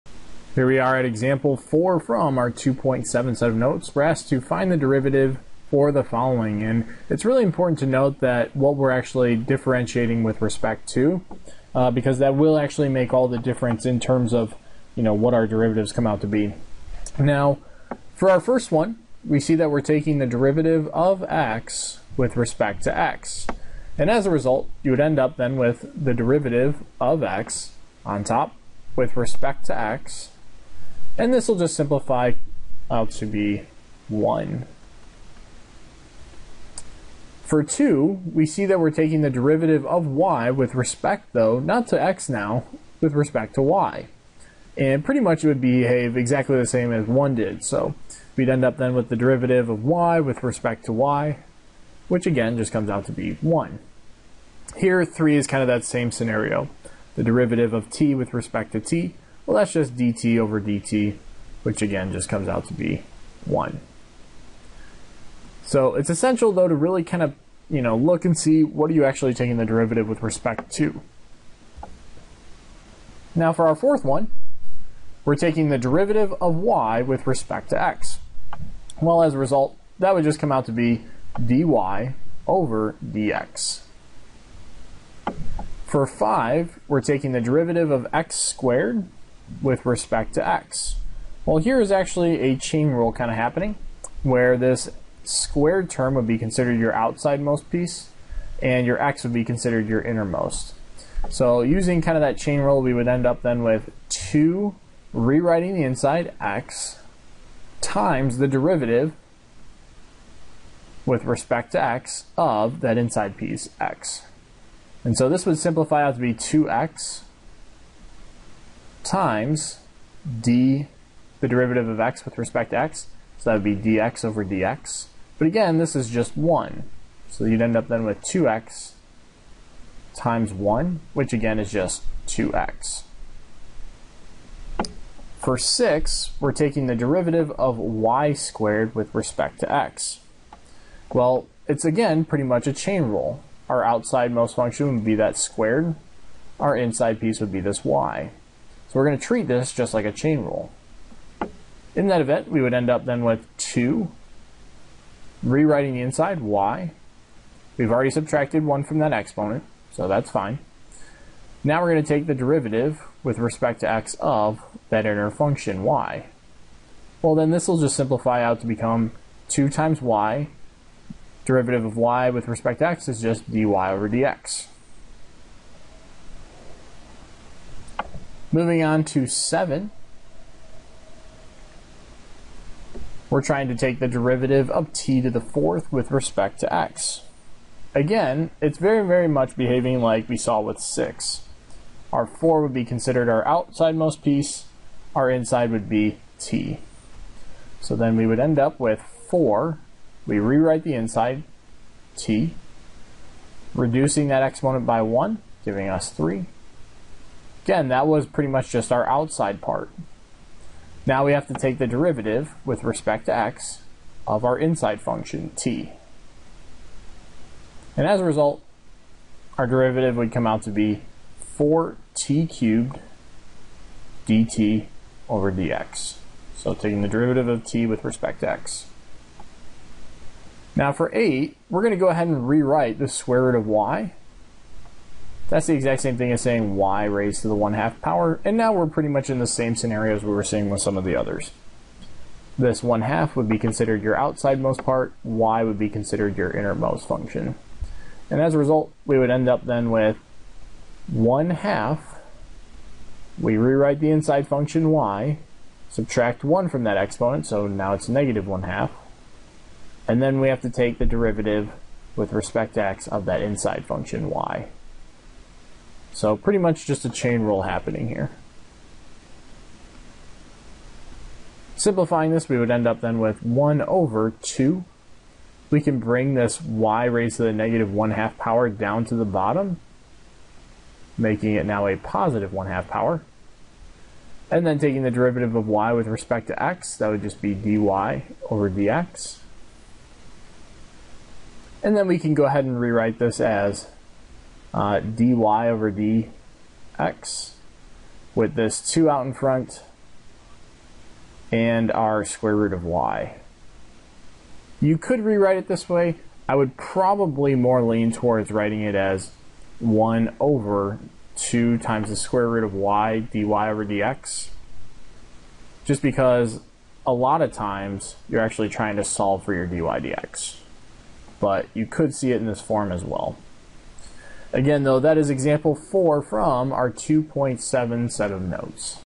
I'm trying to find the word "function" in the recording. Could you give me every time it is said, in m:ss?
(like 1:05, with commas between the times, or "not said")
2:24, 2:45, 3:35, 4:07, 4:14, 4:23.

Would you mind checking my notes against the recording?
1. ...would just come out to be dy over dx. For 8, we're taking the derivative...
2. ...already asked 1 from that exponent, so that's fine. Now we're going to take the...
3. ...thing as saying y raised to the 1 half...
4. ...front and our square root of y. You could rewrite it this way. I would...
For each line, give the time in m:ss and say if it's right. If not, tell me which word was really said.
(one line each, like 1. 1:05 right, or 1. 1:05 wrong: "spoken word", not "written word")
1. 1:20 wrong: "5", not "8"
2. 2:37 wrong: "subtracted", not "asked"
3. 3:56 right
4. 4:59 right.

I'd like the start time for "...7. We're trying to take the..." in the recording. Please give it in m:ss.
2:59.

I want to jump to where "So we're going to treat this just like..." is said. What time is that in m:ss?
2:28.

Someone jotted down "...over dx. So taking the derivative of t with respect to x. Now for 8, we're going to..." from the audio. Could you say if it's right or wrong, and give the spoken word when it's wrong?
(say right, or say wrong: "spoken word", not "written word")
right.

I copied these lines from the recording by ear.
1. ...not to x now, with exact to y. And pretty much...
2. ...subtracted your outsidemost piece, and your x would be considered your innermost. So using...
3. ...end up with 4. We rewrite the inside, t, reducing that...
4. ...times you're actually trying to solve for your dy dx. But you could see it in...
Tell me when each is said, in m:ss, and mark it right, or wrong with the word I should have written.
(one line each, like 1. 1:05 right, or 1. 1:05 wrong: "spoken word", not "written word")
1. 0:41 wrong: "respect", not "exact"
2. 1:36 wrong: "considered", not "subtracted"
3. 3:18 right
4. 5:17 right.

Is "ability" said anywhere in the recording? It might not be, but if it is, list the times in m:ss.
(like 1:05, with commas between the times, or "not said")
not said.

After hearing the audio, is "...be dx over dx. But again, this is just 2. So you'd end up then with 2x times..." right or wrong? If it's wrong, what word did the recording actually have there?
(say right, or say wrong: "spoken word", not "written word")
wrong: "1", not "2".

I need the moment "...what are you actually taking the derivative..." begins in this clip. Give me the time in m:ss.
1:08.